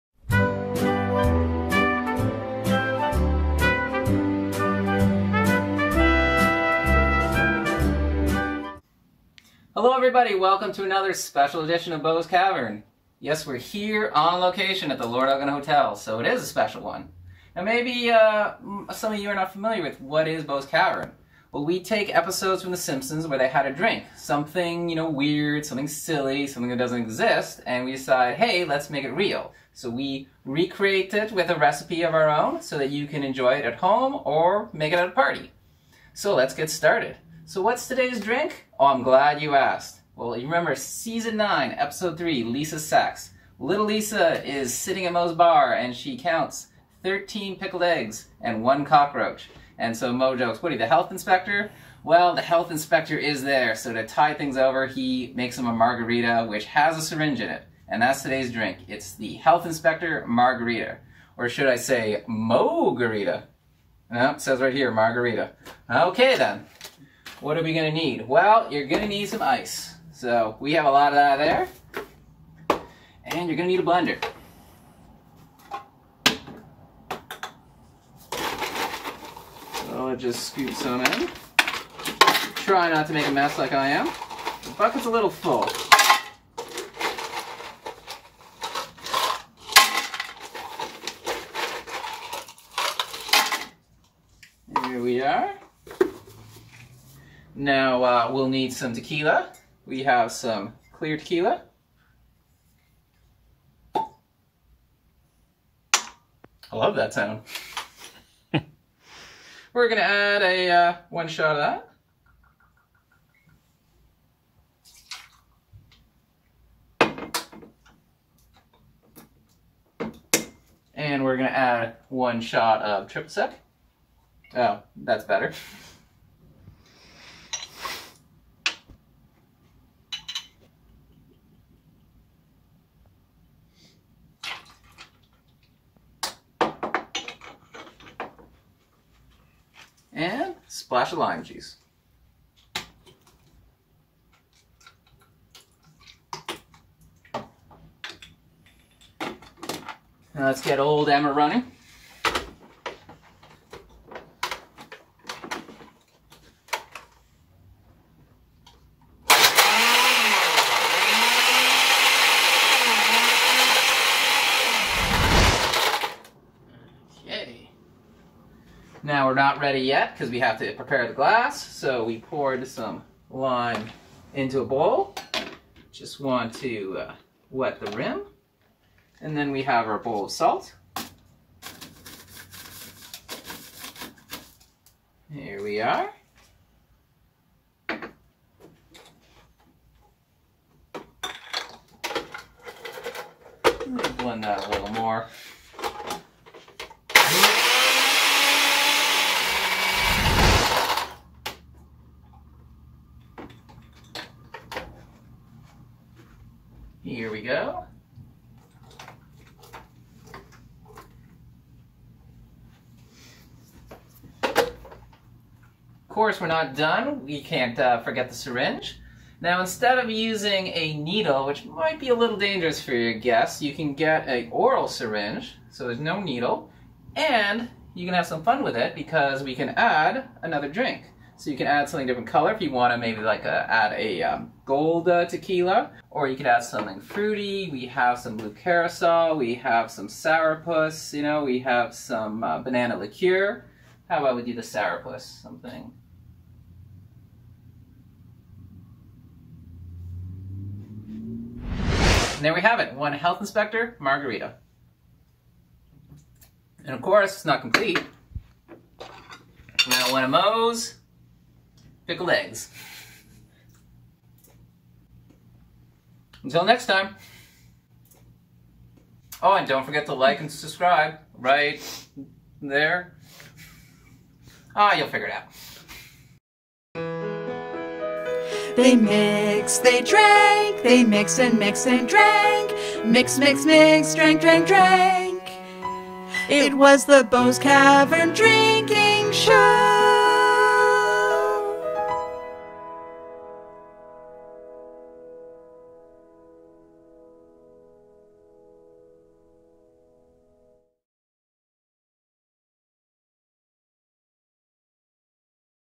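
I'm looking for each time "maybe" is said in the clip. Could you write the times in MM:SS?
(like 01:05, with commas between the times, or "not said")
00:17, 03:52.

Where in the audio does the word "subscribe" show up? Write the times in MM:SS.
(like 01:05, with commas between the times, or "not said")
04:30.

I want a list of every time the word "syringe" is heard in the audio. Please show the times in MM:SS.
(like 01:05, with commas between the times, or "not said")
00:57, 03:38, 03:44.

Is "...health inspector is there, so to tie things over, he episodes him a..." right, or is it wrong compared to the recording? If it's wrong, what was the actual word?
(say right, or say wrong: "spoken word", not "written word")
wrong: "makes", not "episodes".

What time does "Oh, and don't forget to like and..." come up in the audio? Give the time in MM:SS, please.
04:29.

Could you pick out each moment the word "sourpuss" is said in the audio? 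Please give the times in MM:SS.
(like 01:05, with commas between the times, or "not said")
04:00, 04:04.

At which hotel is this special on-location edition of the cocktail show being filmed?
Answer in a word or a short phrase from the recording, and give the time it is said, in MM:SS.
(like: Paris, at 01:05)
Lord Elgin Hotel, at 00:15.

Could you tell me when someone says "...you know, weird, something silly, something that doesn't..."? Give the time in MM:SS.
00:24.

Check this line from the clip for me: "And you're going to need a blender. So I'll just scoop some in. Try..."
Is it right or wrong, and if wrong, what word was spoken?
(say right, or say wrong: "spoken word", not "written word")
right.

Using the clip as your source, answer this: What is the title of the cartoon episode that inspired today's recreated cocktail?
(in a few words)
Lisa's Sax.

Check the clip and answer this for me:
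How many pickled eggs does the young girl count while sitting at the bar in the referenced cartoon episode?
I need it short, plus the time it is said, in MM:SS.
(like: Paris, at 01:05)
13, at 00:47.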